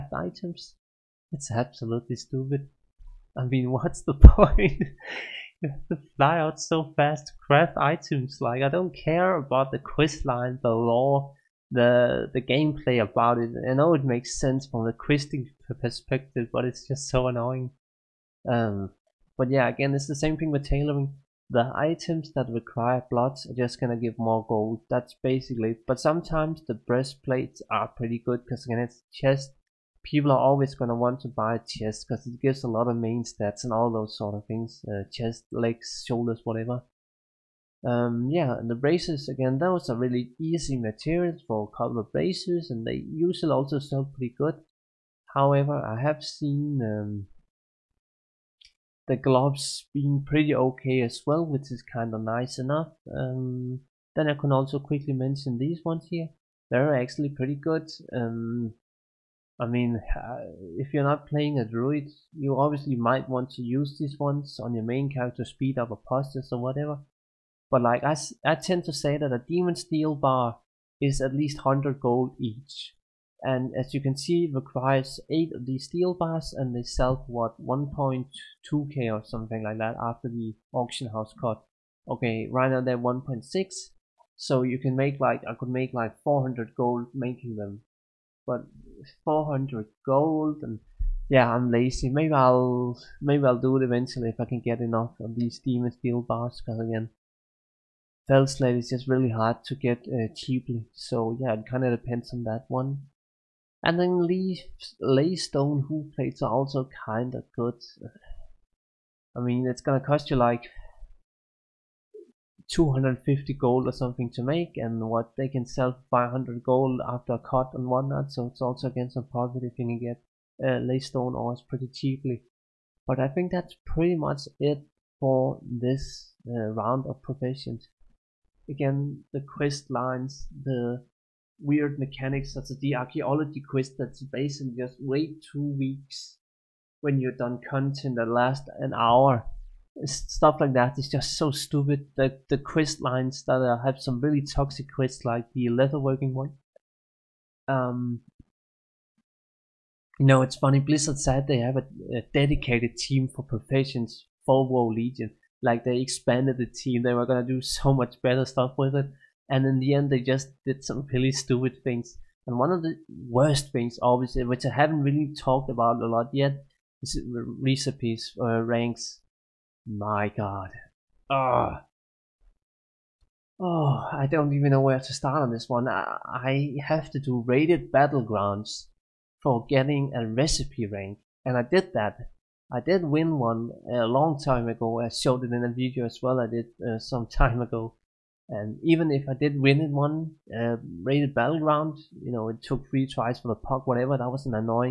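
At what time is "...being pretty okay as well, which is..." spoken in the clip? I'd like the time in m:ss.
0:49.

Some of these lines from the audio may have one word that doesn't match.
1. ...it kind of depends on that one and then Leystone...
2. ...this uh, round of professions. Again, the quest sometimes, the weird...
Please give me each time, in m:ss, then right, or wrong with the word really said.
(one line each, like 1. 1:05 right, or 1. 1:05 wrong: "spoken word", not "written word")
1. 1:41 right
2. 2:05 wrong: "lines", not "sometimes".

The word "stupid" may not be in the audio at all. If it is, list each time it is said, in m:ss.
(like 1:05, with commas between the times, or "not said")
0:02, 2:21, 2:41.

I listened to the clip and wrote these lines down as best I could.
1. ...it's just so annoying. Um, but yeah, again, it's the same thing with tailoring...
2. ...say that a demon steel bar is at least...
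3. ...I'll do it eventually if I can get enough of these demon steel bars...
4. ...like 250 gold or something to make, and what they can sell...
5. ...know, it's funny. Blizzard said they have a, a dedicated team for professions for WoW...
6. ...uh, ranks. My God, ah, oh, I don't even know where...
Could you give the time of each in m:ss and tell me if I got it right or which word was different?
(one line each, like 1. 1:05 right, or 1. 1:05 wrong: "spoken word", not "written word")
1. 0:16 right
2. 1:08 right
3. 1:33 right
4. 1:50 right
5. 2:30 right
6. 2:48 right.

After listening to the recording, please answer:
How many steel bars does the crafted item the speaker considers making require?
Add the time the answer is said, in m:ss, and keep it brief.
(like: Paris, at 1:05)
8, at 1:15.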